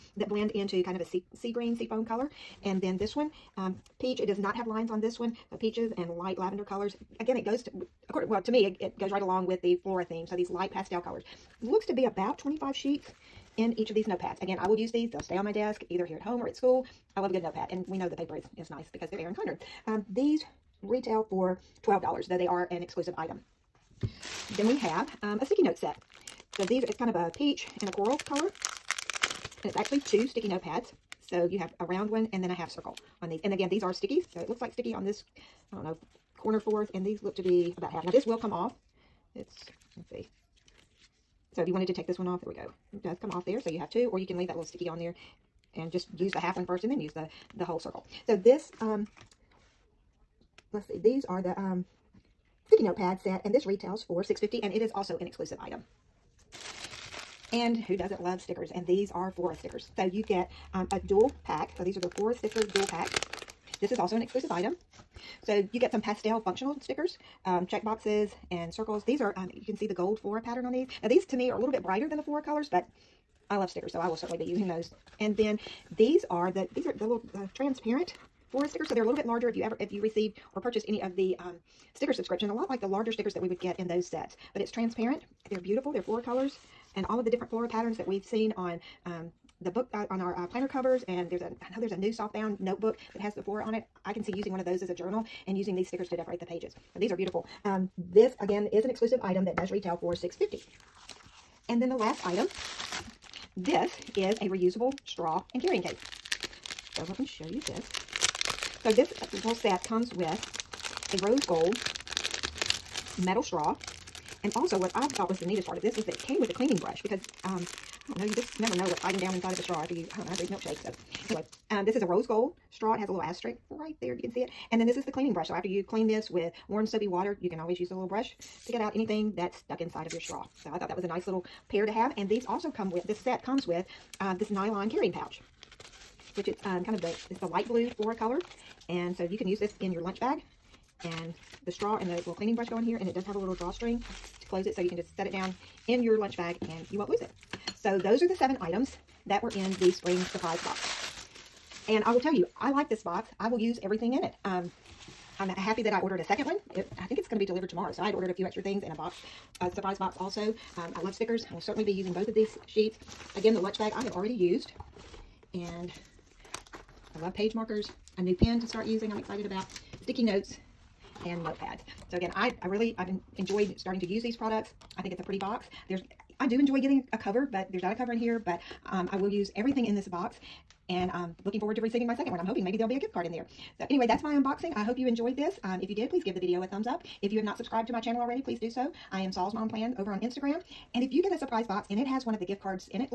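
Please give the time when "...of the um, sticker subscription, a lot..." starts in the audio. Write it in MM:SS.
01:21.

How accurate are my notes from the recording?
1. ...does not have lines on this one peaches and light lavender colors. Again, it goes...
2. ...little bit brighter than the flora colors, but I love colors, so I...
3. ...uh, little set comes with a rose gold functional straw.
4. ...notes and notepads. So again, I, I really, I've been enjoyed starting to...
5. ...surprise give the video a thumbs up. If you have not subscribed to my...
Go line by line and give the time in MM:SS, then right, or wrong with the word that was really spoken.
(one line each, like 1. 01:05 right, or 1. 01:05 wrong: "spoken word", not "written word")
1. 00:04 right
2. 01:11 wrong: "stickers", not "colors"
3. 01:49 wrong: "metal", not "functional"
4. 02:50 right
5. 03:06 wrong: "please", not "surprise".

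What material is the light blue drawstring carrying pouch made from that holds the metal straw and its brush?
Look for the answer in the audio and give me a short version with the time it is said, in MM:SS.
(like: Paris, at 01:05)
Nylon, at 02:14.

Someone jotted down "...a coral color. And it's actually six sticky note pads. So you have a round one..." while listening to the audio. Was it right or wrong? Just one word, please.
wrong.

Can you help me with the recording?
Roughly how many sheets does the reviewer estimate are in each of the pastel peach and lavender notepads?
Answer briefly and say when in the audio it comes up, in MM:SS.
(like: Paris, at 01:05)
25, at 00:12.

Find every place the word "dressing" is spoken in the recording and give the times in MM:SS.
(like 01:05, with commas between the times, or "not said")
not said.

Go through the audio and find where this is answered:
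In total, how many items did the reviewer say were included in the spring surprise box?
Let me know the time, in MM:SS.
02:28.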